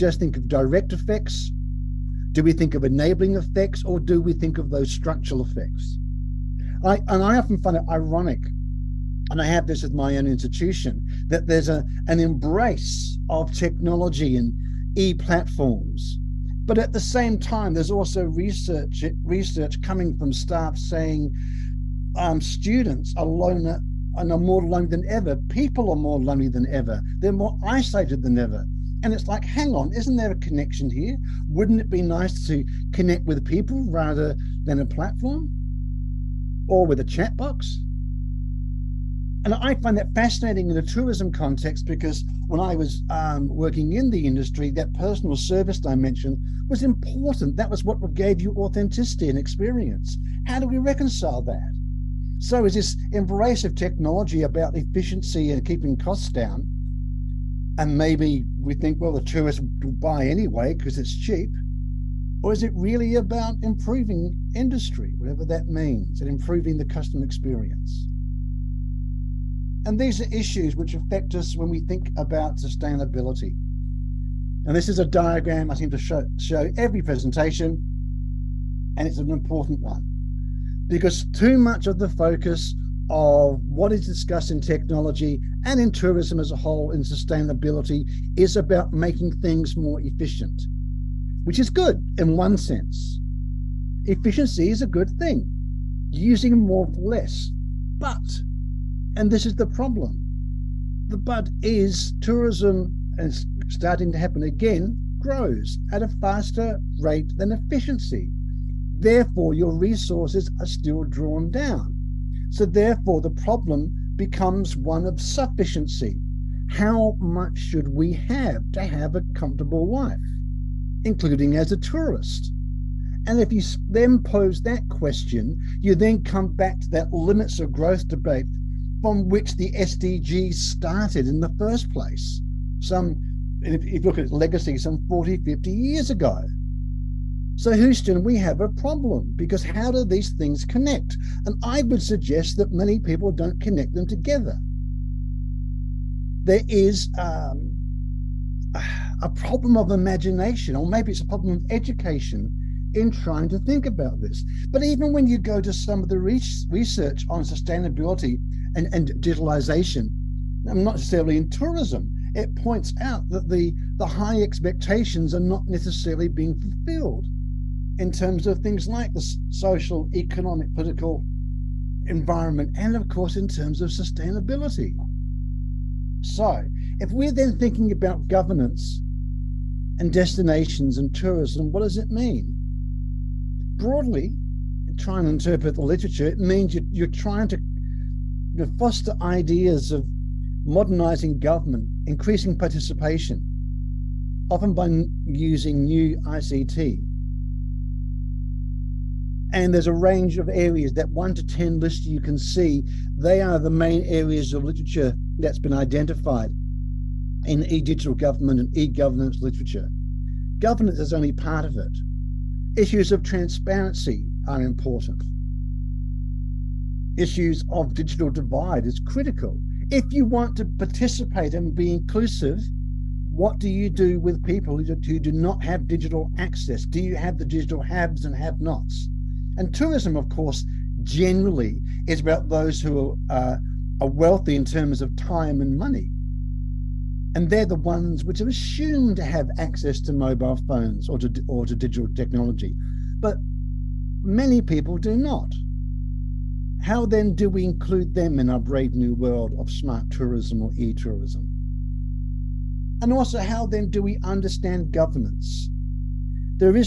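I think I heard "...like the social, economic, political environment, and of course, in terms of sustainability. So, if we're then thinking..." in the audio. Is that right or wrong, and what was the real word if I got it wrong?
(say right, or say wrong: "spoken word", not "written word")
right.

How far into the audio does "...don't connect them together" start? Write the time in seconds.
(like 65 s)
143 s.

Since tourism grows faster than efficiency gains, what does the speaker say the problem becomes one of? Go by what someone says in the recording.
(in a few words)
Sufficiency.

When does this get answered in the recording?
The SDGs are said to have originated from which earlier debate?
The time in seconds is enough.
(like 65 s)
127 s.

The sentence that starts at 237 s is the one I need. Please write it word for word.
And they're the ones which are assumed to have access to mobile phones or to, or to digital technology.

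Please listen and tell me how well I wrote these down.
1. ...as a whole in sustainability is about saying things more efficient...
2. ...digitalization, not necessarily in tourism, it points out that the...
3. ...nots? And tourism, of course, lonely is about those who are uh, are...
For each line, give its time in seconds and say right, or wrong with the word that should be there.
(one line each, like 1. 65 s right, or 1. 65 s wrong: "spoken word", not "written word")
1. 86 s wrong: "making", not "saying"
2. 159 s right
3. 228 s wrong: "generally", not "lonely".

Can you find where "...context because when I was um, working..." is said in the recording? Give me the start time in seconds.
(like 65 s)
41 s.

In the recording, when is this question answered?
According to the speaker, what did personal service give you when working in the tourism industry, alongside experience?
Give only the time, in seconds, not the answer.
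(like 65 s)
48 s.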